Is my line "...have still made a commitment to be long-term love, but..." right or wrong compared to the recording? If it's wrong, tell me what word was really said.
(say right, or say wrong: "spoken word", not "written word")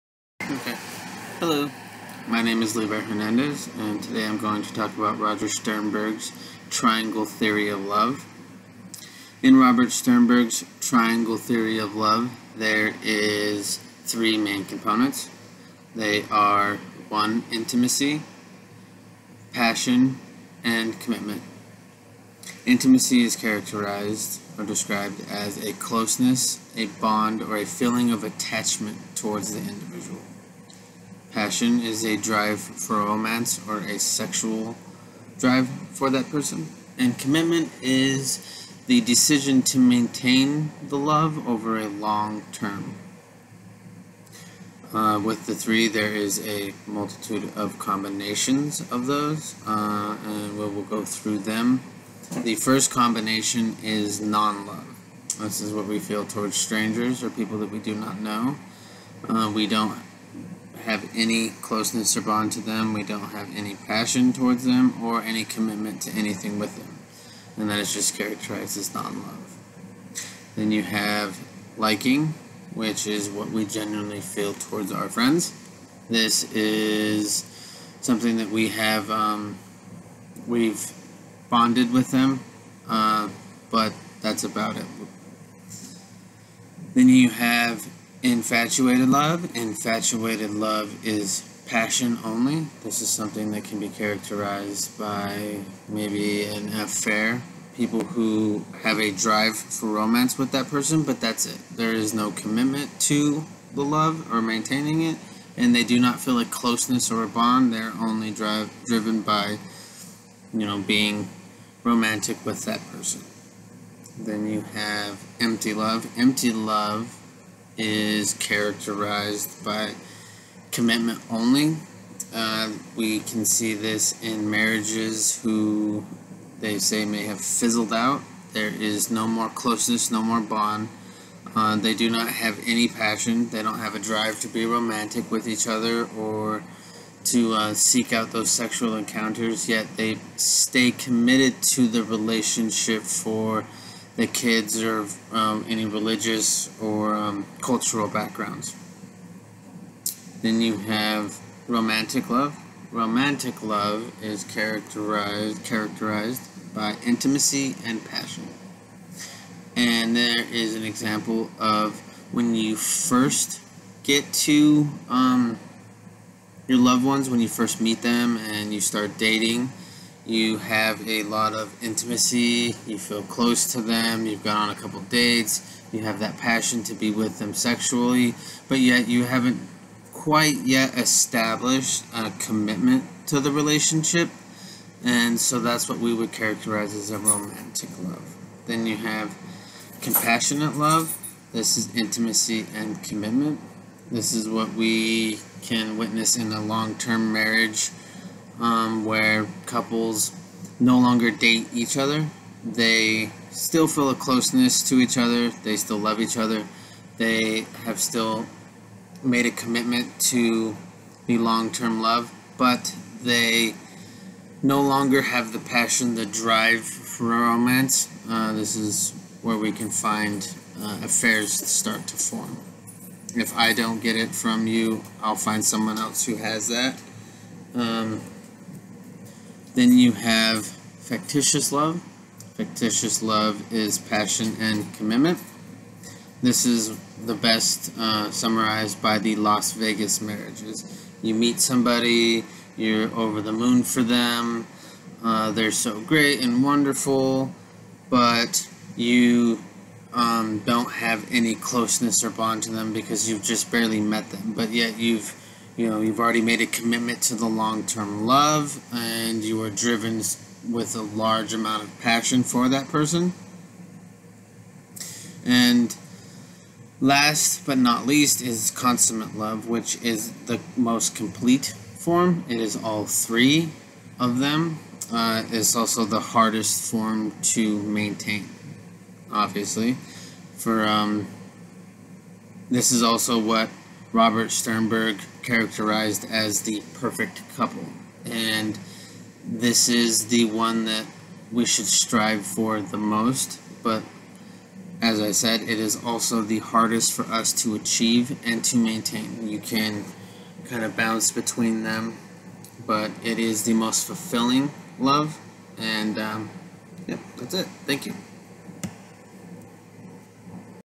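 right.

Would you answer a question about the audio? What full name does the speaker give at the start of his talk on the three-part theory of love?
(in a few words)
Levi Hernandez.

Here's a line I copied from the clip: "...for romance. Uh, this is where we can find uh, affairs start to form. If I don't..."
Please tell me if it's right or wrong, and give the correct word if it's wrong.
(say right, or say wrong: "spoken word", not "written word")
right.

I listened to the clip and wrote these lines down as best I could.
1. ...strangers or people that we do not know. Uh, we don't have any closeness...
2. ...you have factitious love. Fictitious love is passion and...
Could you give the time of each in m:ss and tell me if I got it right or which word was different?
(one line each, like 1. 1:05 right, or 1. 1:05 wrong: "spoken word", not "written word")
1. 0:56 right
2. 3:49 right.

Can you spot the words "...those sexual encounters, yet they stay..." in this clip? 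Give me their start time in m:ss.
2:18.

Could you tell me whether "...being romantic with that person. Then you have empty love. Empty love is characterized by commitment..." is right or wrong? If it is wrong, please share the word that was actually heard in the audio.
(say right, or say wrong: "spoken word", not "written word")
right.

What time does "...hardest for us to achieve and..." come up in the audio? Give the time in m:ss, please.
4:56.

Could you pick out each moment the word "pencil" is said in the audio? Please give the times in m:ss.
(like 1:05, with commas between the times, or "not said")
not said.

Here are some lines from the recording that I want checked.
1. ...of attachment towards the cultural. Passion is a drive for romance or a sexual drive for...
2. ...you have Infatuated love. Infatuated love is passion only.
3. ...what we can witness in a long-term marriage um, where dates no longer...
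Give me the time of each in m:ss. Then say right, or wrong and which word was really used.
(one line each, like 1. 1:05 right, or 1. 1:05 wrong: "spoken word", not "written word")
1. 0:28 wrong: "individual", not "cultural"
2. 1:27 right
3. 3:14 wrong: "couples", not "dates".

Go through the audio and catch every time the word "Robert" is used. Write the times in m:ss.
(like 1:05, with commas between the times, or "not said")
0:09, 4:44.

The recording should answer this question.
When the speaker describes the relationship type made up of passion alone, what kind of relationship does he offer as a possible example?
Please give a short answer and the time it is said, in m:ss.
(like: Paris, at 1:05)
an affair, at 1:36.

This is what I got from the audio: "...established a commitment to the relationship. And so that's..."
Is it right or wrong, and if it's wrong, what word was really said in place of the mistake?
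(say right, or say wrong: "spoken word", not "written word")
right.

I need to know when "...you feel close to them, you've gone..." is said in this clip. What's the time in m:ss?
2:52.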